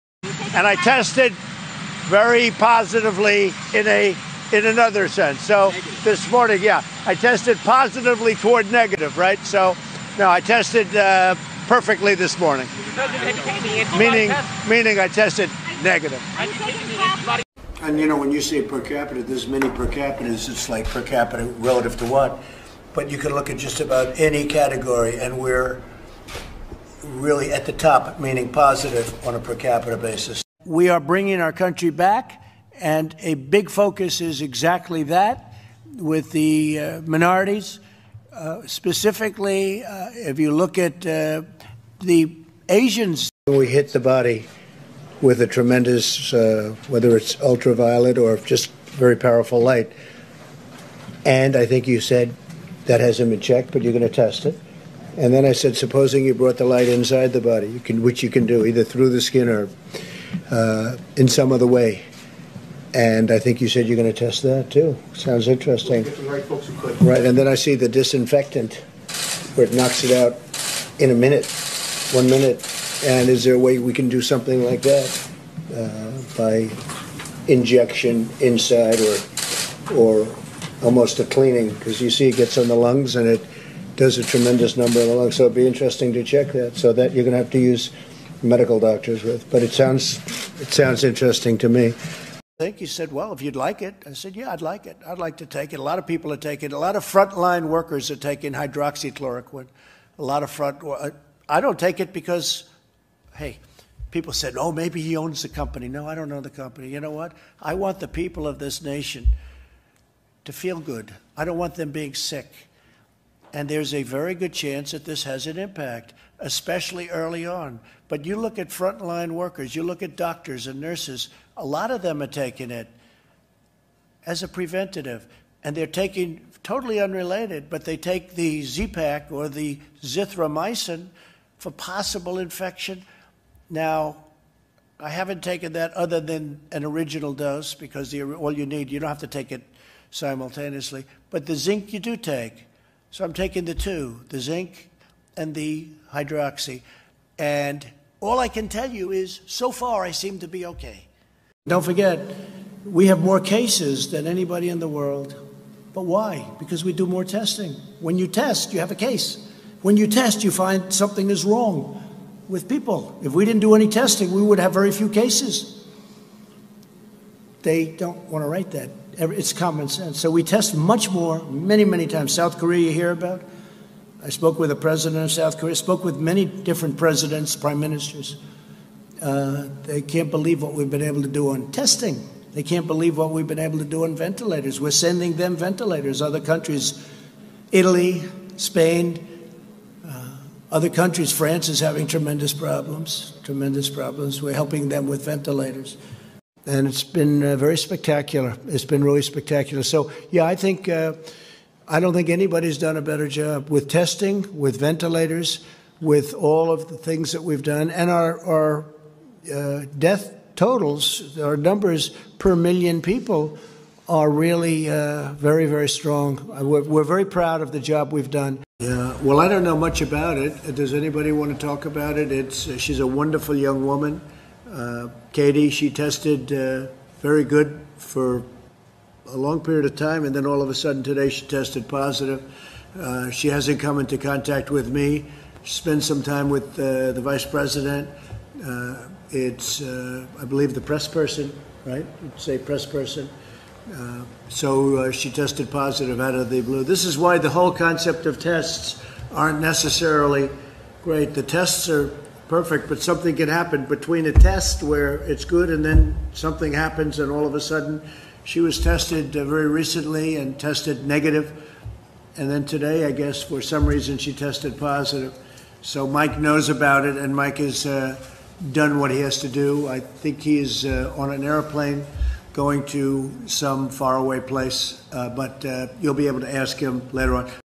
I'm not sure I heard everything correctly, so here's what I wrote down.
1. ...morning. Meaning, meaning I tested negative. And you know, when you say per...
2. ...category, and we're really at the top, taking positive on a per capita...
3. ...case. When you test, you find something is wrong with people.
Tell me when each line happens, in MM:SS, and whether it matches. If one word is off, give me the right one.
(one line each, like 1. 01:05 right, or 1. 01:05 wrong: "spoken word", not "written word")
1. 00:12 right
2. 00:24 wrong: "meaning", not "taking"
3. 02:38 right.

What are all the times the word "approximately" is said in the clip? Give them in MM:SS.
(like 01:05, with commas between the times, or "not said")
not said.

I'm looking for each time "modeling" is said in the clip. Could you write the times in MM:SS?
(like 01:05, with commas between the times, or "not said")
not said.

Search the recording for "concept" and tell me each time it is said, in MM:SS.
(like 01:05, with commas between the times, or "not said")
04:07.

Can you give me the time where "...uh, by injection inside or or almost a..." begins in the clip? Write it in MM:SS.
01:15.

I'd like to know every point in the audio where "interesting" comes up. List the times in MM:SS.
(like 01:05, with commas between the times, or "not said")
01:05, 01:25, 01:31.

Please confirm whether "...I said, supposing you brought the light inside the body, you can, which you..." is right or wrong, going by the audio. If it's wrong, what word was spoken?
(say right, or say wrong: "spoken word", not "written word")
right.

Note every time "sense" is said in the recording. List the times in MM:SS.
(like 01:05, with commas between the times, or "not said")
00:05, 02:49.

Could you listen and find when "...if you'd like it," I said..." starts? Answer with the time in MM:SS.
01:33.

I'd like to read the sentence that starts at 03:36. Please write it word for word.
Uh, we're, we're, very proud of the job we've done.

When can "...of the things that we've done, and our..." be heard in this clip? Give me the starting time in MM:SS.
03:26.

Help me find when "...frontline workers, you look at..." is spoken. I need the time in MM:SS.
01:58.